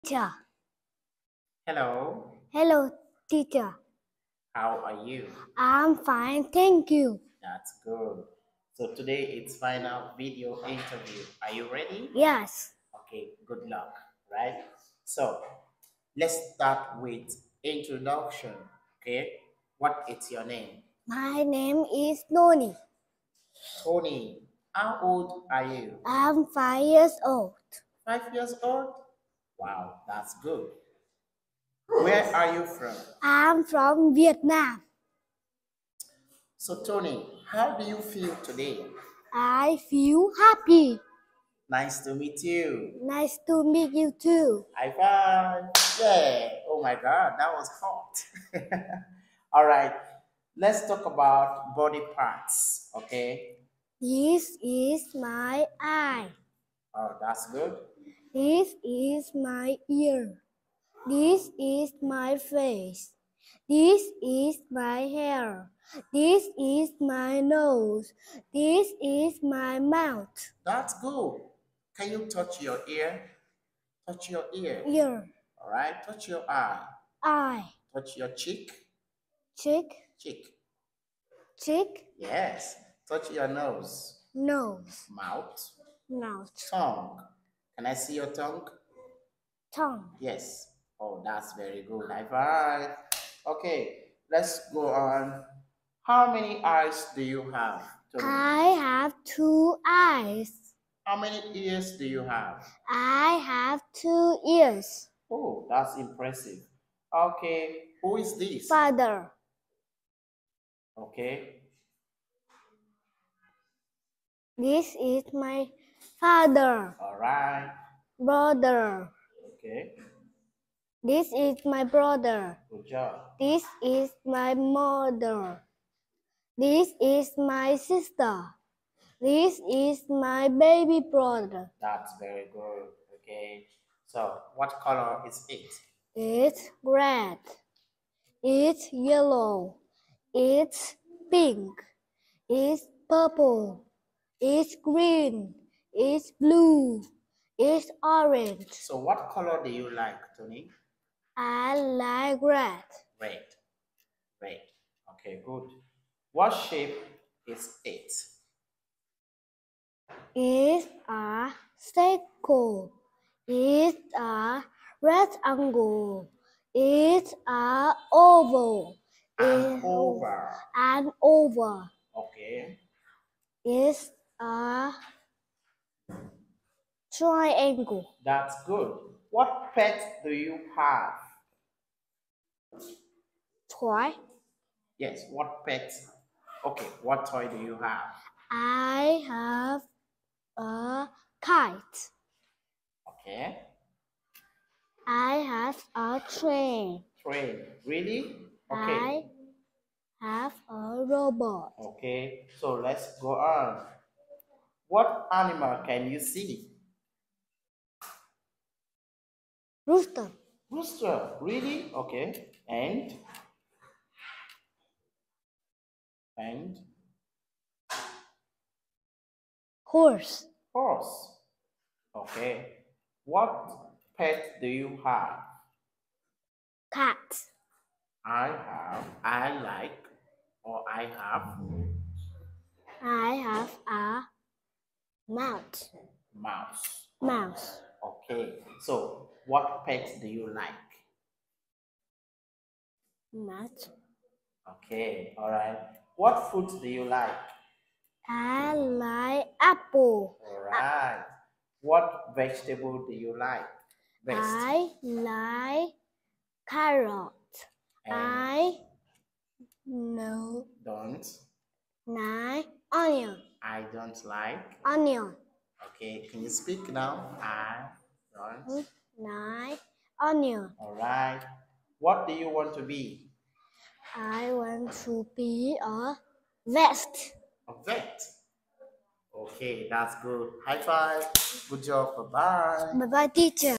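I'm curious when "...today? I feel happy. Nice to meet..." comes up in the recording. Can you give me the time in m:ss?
0:38.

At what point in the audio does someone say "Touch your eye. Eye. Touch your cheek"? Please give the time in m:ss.
1:16.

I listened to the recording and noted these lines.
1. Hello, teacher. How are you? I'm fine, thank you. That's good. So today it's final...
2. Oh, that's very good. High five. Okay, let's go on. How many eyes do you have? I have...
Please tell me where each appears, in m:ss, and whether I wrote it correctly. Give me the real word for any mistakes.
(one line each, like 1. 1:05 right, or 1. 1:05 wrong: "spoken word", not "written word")
1. 0:02 right
2. 1:30 right.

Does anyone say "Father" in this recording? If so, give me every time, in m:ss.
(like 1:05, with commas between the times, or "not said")
1:48, 1:56.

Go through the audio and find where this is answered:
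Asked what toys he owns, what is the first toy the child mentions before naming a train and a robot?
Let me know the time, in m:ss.
3:11.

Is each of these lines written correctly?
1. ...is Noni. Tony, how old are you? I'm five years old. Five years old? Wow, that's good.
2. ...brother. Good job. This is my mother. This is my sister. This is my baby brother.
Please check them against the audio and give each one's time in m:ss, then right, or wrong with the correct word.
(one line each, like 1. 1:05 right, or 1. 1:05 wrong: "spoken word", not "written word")
1. 0:21 right
2. 2:01 right.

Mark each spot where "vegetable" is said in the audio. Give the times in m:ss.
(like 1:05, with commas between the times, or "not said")
4:12.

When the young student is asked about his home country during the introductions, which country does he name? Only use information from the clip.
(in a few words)
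Vietnam.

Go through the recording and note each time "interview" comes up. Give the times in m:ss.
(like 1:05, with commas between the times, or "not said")
0:10.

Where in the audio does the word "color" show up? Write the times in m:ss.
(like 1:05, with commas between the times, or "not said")
2:14, 2:29.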